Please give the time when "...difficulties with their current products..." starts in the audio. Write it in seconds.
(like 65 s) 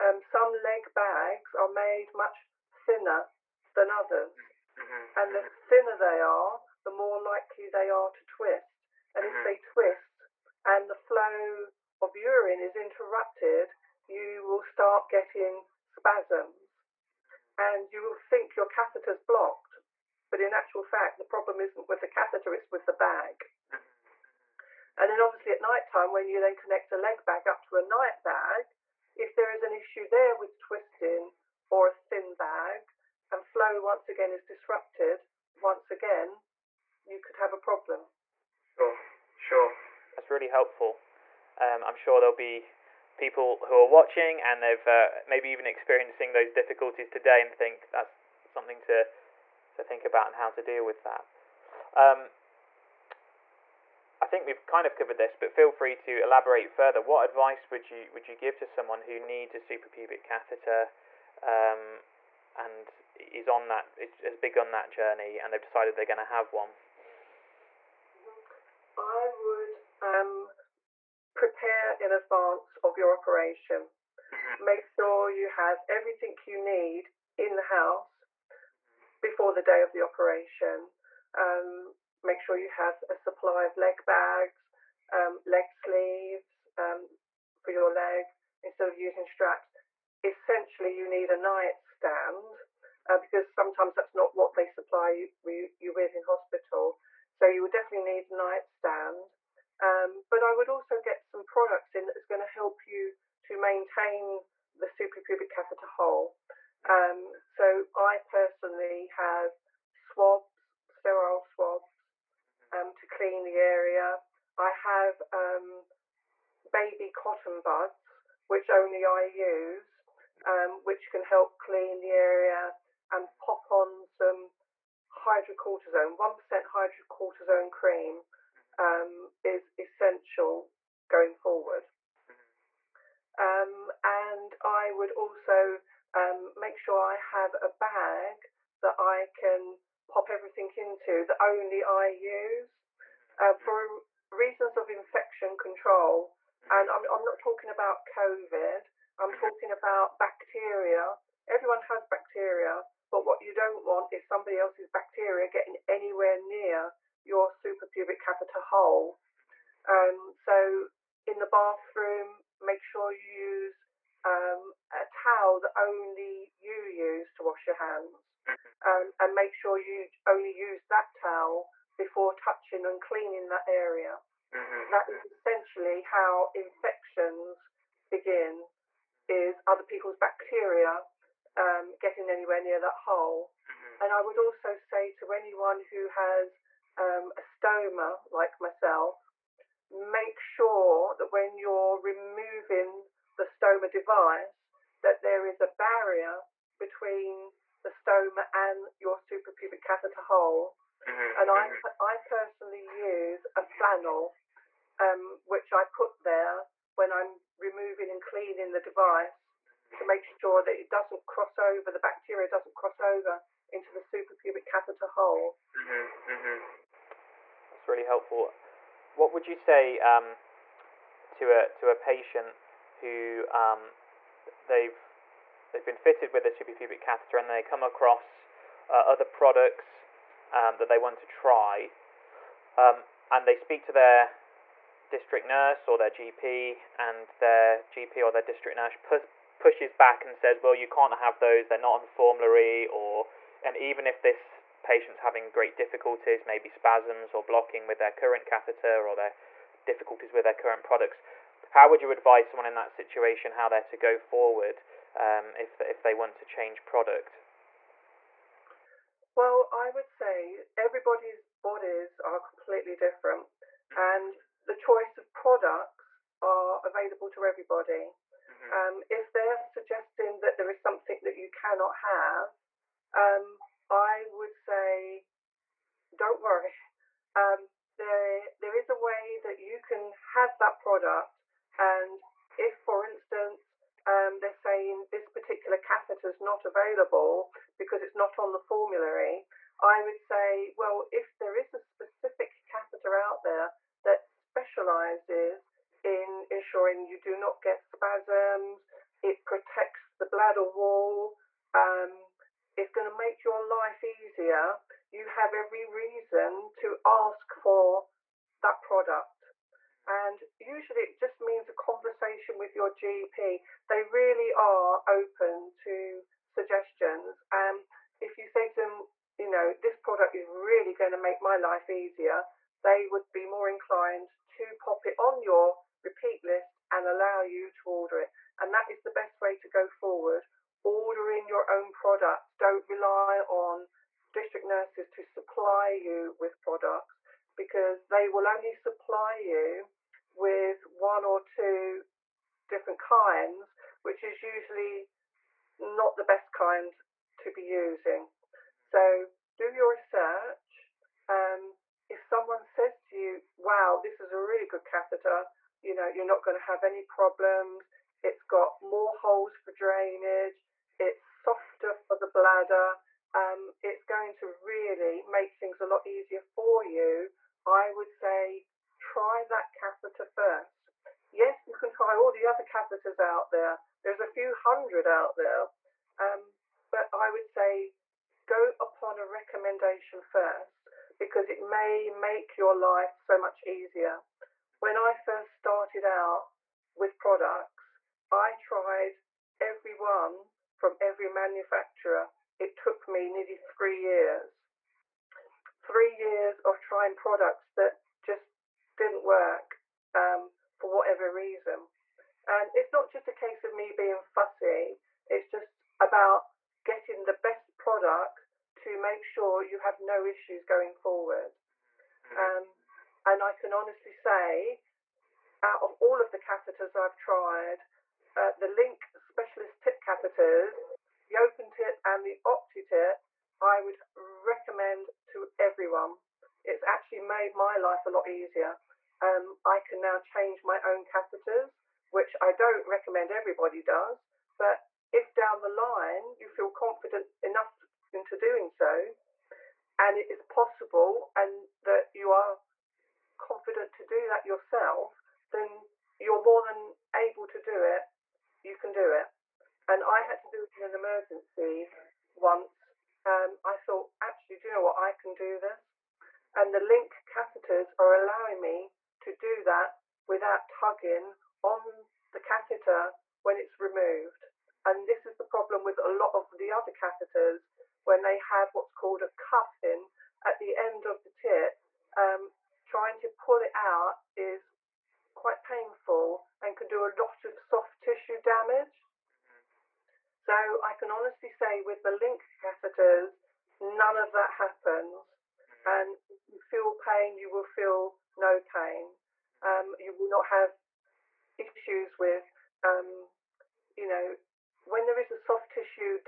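249 s.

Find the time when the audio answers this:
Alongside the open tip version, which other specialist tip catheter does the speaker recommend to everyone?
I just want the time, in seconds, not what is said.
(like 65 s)
422 s.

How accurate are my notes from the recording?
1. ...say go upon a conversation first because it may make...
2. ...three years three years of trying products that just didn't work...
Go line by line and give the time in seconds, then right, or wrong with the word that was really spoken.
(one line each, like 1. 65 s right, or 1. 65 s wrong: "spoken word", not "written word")
1. 377 s wrong: "recommendation", not "conversation"
2. 393 s right.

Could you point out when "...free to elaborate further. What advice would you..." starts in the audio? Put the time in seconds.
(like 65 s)
55 s.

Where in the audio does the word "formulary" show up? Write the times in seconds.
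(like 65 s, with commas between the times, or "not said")
242 s, 288 s.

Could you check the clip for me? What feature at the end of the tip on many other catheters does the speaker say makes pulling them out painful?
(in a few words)
A cuff.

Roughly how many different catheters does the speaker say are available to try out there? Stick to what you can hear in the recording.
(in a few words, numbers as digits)
A few hundred.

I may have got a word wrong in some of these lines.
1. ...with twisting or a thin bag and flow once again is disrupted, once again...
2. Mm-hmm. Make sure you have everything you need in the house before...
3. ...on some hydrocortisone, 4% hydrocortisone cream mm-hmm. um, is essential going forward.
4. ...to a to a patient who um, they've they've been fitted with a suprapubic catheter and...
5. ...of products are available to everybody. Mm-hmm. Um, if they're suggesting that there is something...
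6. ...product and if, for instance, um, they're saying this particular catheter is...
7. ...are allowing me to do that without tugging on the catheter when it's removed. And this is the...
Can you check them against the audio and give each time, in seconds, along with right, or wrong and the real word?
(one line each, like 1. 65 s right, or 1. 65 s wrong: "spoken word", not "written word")
1. 30 s right
2. 74 s right
3. 123 s wrong: "1", not "4"
4. 221 s right
5. 265 s right
6. 280 s right
7. 457 s right.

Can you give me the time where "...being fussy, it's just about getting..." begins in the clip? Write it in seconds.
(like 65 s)
403 s.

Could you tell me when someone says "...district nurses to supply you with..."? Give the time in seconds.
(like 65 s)
334 s.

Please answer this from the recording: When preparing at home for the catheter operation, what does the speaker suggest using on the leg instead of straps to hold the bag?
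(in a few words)
Leg sleeves.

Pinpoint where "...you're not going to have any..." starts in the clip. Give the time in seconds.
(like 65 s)
356 s.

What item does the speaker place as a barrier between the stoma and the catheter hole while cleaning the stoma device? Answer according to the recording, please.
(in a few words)
A flannel.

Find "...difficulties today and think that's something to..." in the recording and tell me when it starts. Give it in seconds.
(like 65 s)
46 s.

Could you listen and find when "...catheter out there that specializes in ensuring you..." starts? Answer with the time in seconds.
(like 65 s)
292 s.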